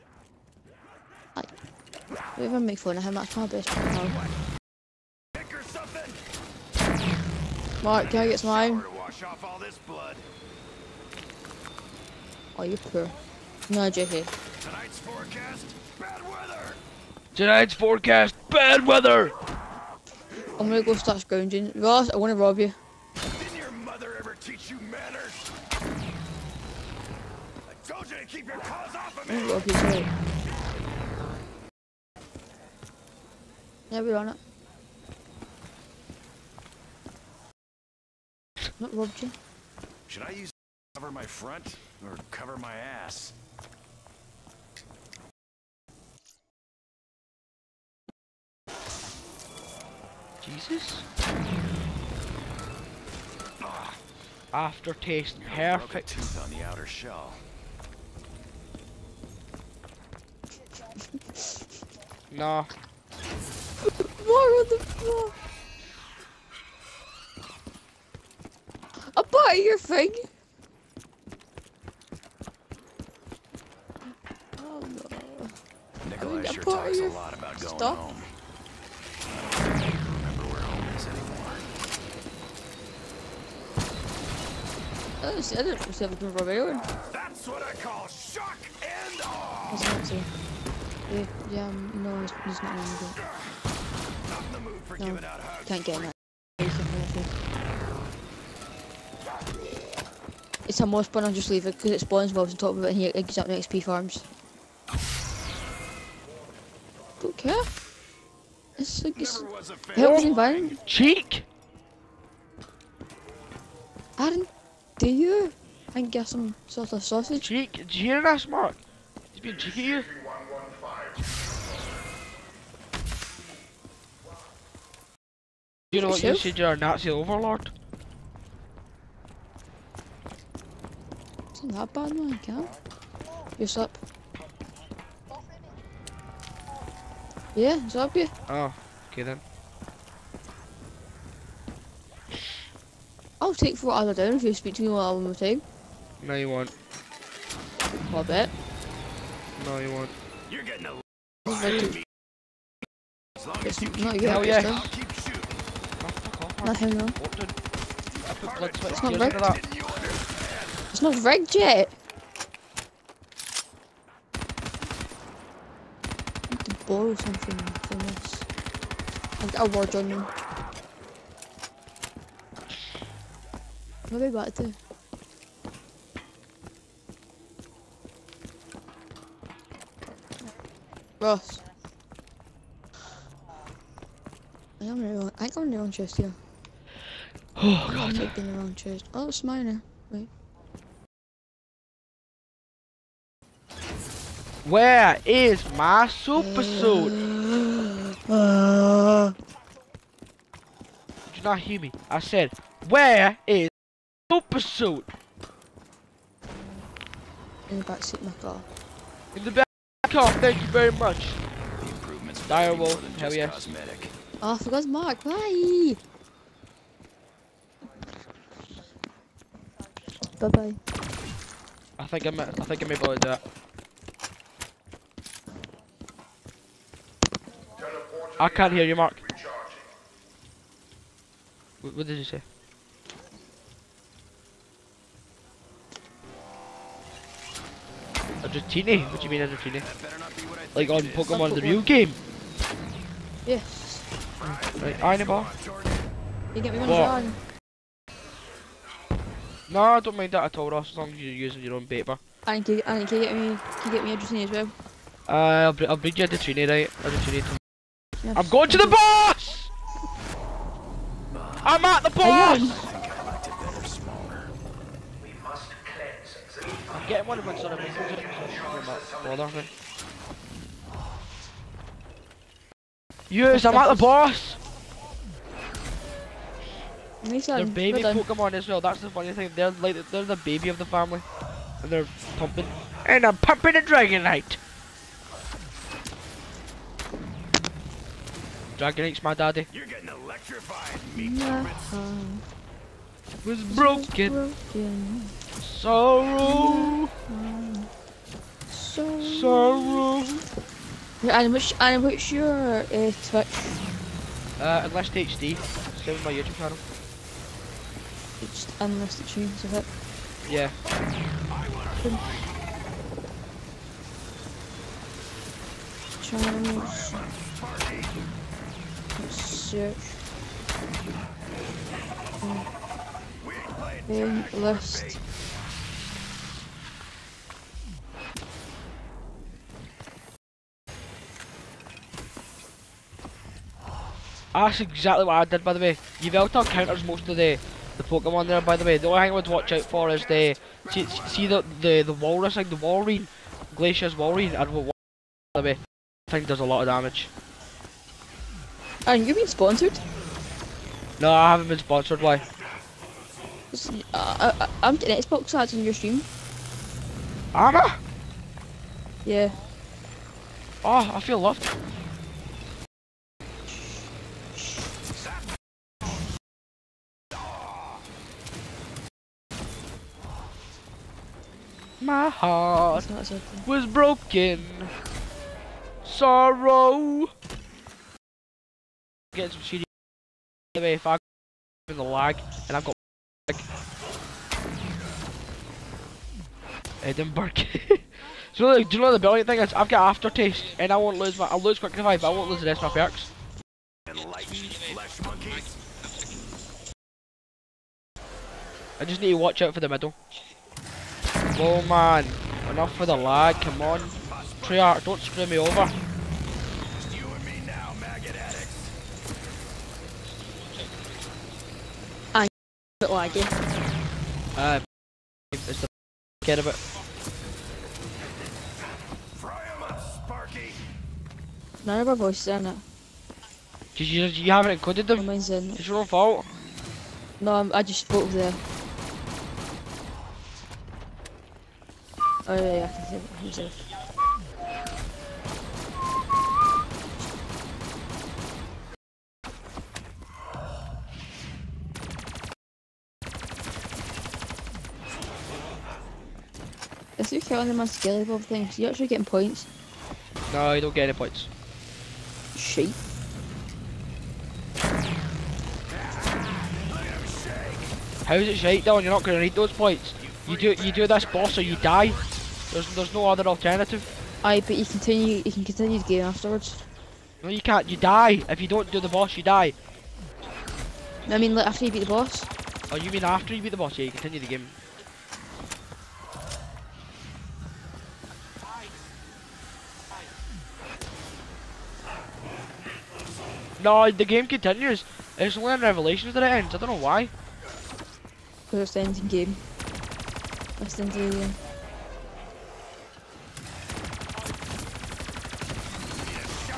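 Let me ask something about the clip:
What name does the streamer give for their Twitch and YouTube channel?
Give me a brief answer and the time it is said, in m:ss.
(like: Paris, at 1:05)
Enlist HD, at 5:04.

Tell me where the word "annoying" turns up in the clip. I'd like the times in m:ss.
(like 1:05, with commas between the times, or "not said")
not said.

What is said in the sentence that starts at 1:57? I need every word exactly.
Cheek, do you hear that, Mark?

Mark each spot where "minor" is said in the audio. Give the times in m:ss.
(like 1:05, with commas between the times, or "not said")
3:09.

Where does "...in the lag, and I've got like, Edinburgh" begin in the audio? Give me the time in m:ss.
6:21.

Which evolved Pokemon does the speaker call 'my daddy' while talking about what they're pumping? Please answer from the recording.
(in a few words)
Dragonite.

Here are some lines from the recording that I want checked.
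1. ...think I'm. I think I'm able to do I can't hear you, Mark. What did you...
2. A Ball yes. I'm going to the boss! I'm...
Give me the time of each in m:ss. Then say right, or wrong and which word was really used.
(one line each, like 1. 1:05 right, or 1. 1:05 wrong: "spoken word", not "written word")
1. 3:42 right
2. 4:17 wrong: "Dratini", not "Ball".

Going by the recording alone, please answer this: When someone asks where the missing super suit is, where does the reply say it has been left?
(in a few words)
Back seat of my car.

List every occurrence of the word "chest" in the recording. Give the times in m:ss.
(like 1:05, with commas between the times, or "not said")
3:05.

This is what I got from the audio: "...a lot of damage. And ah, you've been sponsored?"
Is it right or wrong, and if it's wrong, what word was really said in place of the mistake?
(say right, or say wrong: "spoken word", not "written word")
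right.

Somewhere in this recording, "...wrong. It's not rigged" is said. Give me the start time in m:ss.
2:36.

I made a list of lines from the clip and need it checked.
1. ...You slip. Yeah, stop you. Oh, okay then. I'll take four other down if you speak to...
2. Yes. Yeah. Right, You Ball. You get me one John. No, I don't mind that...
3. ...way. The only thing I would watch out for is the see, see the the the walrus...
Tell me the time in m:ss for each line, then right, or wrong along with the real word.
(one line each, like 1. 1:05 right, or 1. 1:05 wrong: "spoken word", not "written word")
1. 2:13 right
2. 4:03 wrong: "Iron", not "You"
3. 5:38 right.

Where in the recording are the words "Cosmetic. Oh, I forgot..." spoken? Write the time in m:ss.
3:33.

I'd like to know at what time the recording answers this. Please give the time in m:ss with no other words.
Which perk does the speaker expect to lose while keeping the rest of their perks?
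6:31.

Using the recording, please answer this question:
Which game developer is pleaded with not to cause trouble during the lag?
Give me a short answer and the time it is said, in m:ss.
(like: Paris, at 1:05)
Treyarch, at 6:44.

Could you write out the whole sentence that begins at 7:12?
Oh yeah, yeah, he's in himself.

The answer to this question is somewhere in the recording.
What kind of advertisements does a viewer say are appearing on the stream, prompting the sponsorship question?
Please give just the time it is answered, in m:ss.
5:55.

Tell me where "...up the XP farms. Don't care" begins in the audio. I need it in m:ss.
1:43.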